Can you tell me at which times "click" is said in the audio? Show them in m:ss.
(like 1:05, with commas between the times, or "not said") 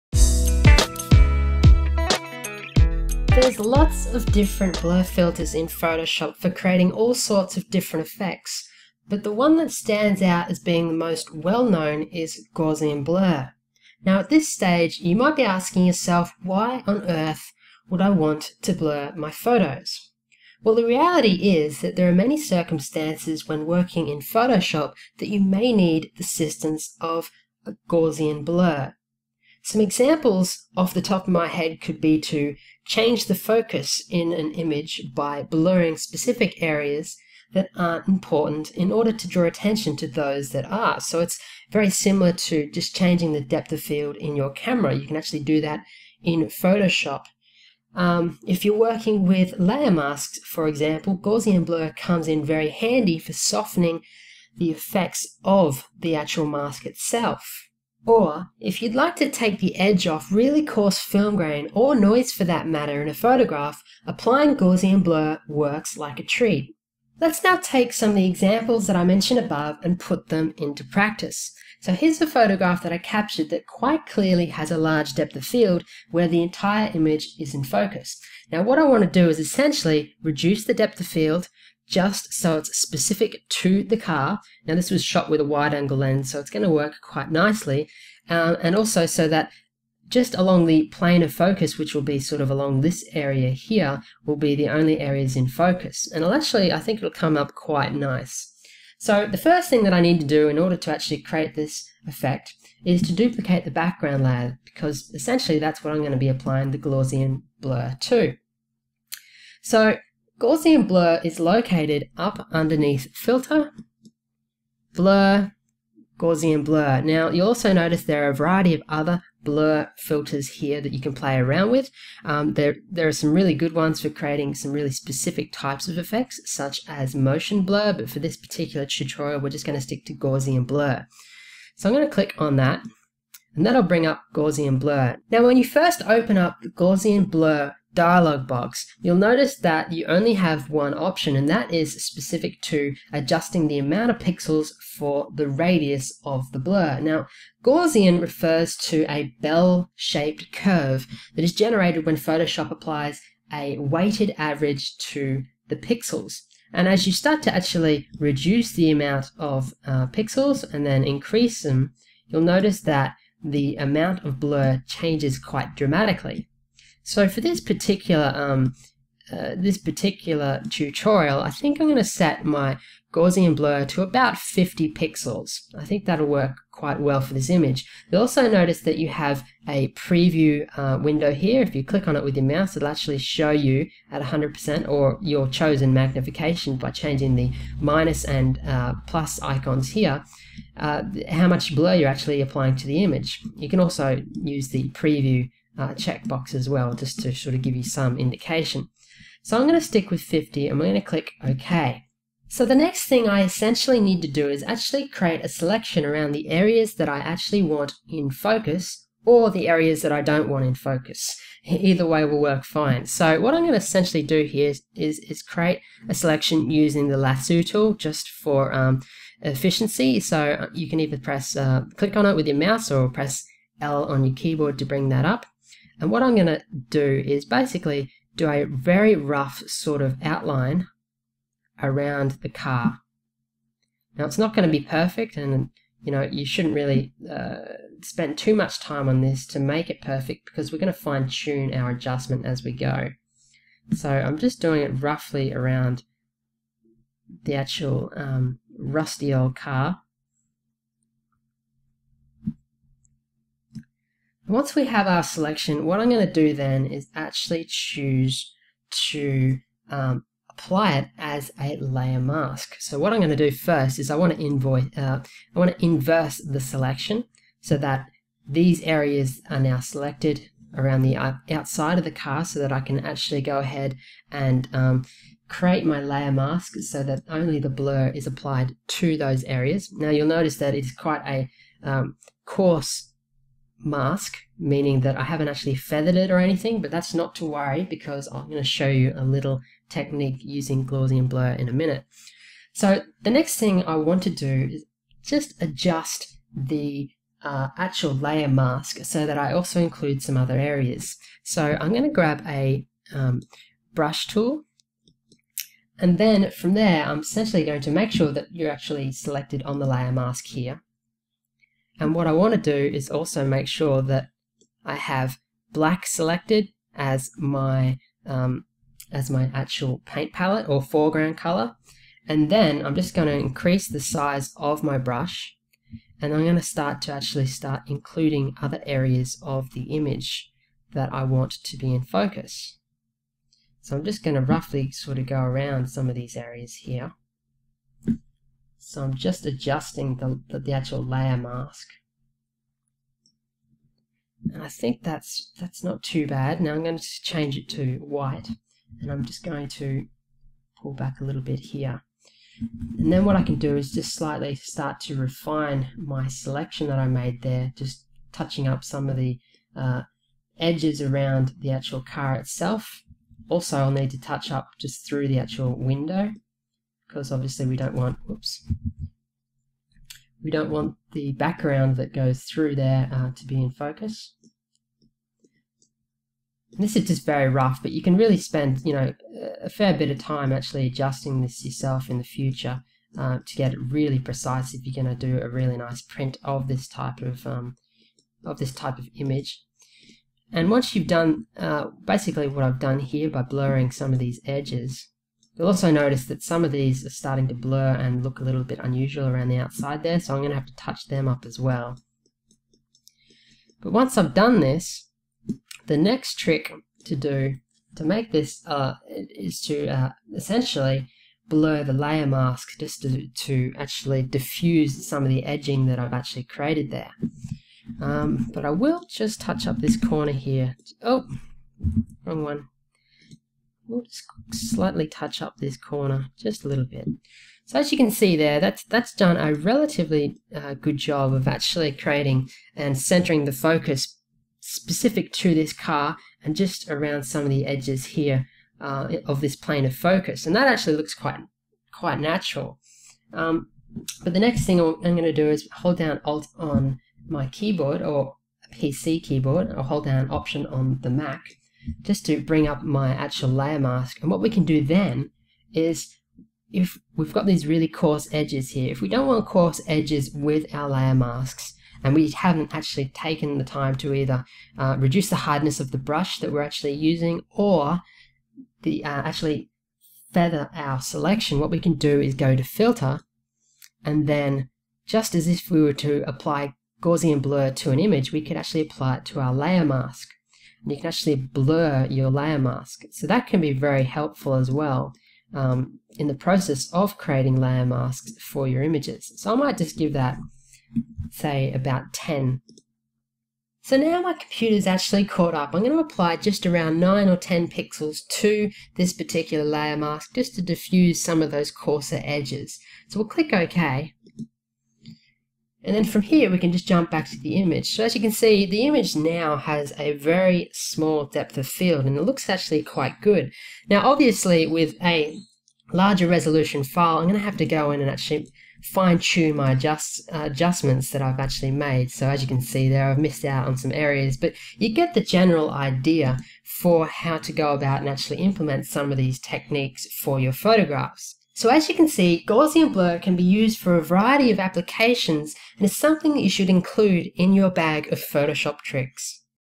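2:12, 3:01, 3:21, 3:41, 8:23.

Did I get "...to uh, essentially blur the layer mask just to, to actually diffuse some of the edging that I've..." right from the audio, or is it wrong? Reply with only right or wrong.
right.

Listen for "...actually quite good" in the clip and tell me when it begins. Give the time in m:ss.
8:32.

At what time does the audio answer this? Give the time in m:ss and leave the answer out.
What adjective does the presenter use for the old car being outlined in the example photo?
4:08.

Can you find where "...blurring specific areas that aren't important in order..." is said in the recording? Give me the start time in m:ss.
0:35.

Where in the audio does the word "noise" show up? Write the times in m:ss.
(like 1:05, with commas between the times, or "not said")
1:01.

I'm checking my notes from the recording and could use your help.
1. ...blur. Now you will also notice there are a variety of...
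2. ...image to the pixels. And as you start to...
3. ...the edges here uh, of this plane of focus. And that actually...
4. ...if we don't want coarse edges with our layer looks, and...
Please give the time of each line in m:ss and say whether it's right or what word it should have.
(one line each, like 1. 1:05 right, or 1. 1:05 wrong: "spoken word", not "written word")
1. 1:56 right
2. 2:34 wrong: "average", not "image"
3. 7:17 right
4. 7:38 wrong: "masks", not "looks".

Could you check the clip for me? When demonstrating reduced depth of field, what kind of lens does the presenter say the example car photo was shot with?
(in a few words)
wide angle lens.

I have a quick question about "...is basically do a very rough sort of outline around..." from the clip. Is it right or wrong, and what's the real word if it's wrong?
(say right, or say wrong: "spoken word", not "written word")
right.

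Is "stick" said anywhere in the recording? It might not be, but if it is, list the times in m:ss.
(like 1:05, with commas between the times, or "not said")
2:09, 3:19.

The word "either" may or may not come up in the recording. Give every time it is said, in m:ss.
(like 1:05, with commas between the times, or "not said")
3:31, 3:40, 7:44.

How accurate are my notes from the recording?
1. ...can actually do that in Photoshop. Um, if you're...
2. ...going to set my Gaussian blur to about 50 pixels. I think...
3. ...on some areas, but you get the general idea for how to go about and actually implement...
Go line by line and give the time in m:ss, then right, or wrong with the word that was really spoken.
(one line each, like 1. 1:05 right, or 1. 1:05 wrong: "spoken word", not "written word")
1. 0:45 right
2. 2:51 right
3. 8:43 right.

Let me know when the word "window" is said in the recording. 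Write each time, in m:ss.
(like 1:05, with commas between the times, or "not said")
3:01, 6:05.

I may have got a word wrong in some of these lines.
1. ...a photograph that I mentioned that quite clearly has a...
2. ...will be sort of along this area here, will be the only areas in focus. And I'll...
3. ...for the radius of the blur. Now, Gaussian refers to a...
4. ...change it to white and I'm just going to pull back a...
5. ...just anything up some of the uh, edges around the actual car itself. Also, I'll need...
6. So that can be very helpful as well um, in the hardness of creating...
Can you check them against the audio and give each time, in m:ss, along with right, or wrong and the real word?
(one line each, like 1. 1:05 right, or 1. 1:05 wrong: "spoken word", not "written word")
1. 1:12 wrong: "captured", not "mentioned"
2. 1:31 right
3. 2:24 right
4. 5:47 right
5. 5:57 wrong: "touching", not "anything"
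6. 8:03 wrong: "process", not "hardness".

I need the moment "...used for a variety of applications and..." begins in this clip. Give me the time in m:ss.
8:53.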